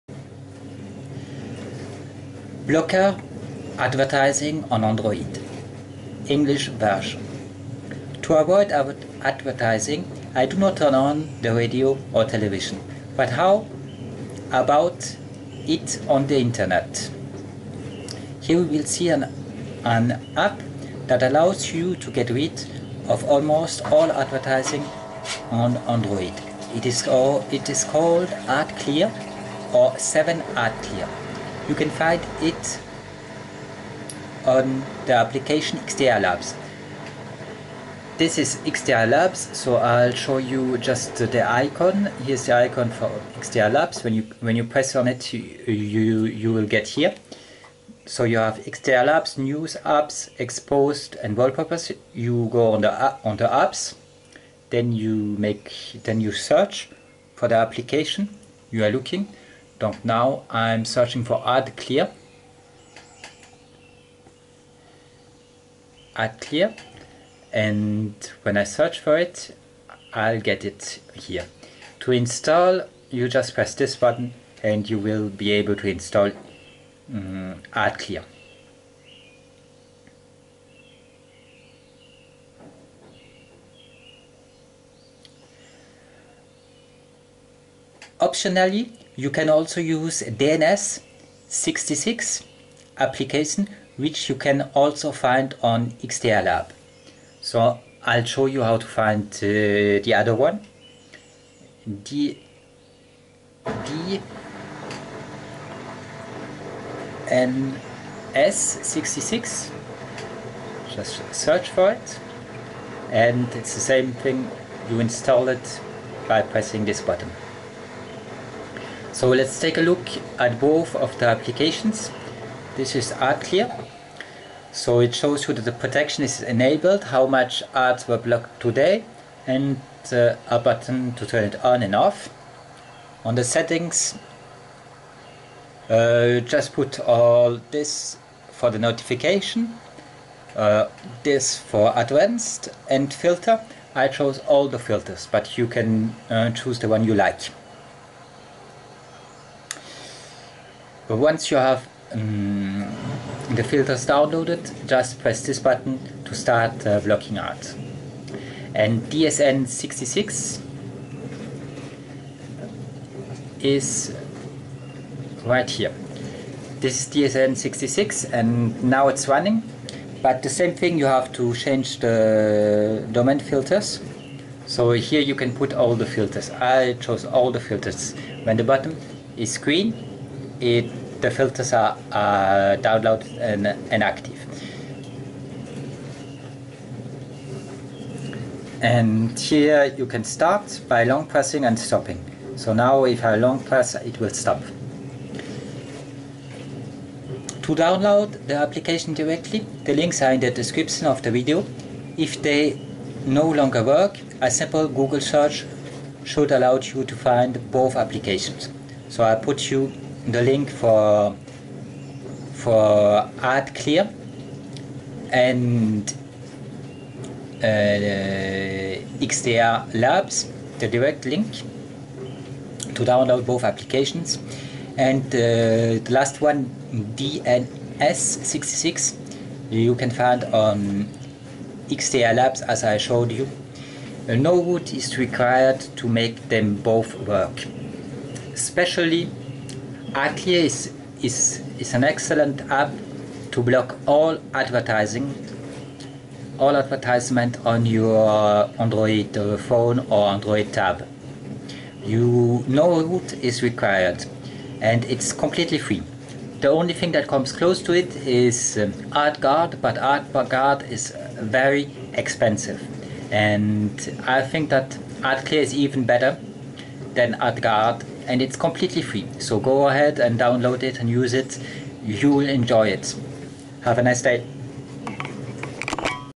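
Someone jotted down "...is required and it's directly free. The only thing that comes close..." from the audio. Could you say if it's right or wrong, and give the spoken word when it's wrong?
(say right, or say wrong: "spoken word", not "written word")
wrong: "completely", not "directly".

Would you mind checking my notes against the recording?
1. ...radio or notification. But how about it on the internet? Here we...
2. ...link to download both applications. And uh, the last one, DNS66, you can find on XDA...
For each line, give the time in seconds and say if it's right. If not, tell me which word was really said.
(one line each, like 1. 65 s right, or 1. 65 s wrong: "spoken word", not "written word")
1. 11 s wrong: "television", not "notification"
2. 221 s right.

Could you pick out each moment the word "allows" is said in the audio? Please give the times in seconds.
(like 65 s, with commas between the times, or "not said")
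21 s, 206 s.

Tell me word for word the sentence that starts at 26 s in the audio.
It is, it is called AdClear or 7AdClear.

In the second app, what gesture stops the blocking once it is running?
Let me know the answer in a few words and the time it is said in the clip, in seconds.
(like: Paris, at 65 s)
long pressing, at 191 s.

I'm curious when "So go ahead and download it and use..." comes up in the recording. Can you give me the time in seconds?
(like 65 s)
269 s.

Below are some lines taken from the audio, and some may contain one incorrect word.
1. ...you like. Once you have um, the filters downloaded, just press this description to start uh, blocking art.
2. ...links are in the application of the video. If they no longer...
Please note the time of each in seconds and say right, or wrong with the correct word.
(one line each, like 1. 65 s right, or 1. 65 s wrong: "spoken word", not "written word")
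1. 147 s wrong: "button", not "description"
2. 199 s wrong: "description", not "application".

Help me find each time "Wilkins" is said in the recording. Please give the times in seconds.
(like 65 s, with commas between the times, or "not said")
not said.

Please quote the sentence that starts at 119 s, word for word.
So let's take a look at both of the applications.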